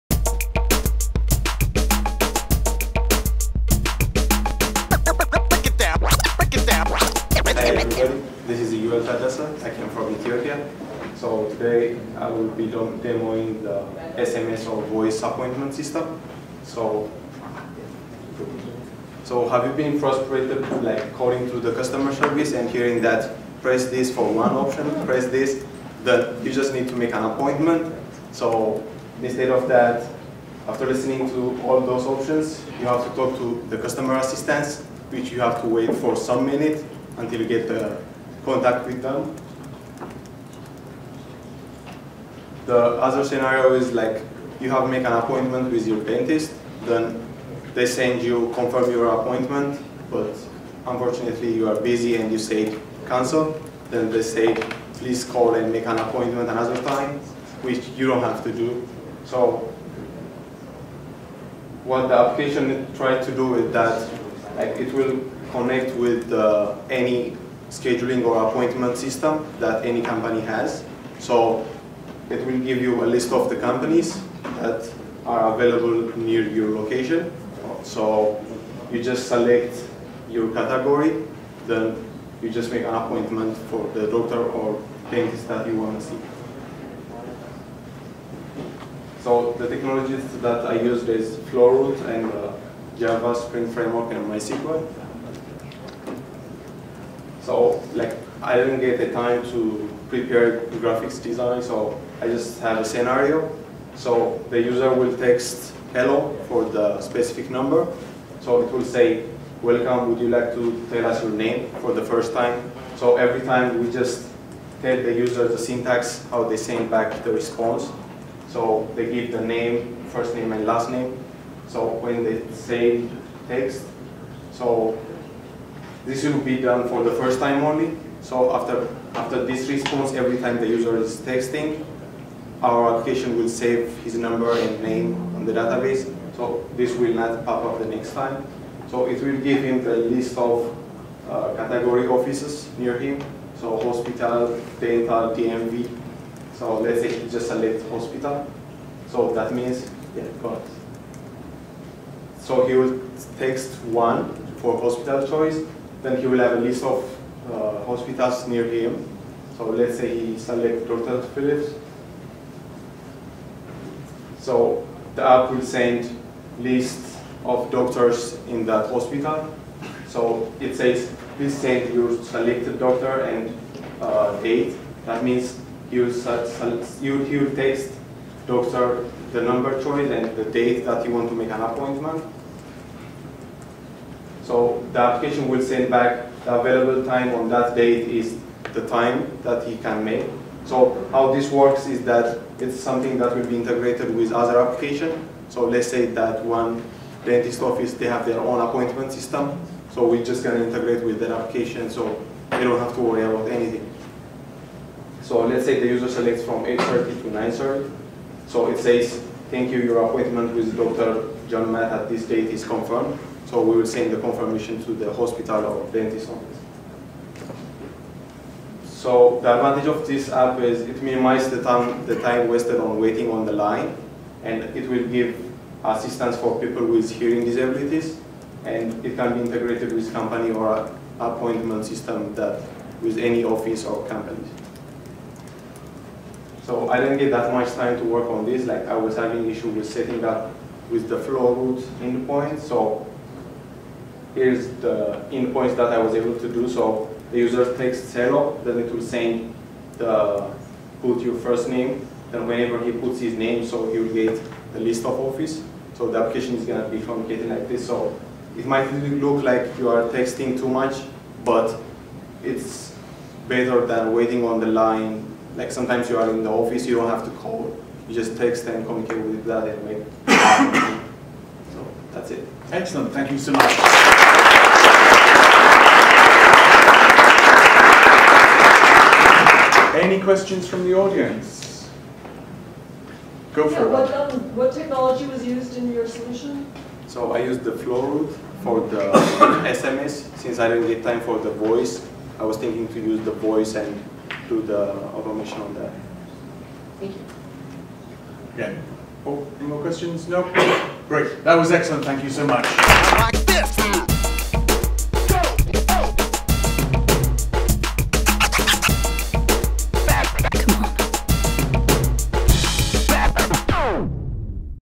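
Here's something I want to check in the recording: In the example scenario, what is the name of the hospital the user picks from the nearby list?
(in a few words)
Dr. Phillips.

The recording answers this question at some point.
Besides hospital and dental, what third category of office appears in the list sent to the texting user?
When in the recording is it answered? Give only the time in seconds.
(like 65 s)
145 s.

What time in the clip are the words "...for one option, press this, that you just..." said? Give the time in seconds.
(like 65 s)
24 s.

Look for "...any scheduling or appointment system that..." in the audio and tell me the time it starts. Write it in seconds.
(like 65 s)
66 s.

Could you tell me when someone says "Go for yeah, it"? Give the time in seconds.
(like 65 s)
283 s.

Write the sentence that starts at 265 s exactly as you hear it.
Like sometimes you are in the office, you don't have to call.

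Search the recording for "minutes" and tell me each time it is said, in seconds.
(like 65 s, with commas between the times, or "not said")
36 s.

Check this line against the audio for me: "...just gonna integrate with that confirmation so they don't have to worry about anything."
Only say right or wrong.
wrong.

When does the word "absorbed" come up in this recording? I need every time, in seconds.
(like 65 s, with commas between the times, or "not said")
not said.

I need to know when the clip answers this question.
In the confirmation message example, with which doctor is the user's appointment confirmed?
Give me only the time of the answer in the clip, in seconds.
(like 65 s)
210 s.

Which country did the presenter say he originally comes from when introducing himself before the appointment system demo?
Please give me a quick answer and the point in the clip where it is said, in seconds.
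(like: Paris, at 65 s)
Ethiopia, at 10 s.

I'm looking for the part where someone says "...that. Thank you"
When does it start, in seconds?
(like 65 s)
295 s.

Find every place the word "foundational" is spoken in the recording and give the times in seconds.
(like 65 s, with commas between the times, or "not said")
not said.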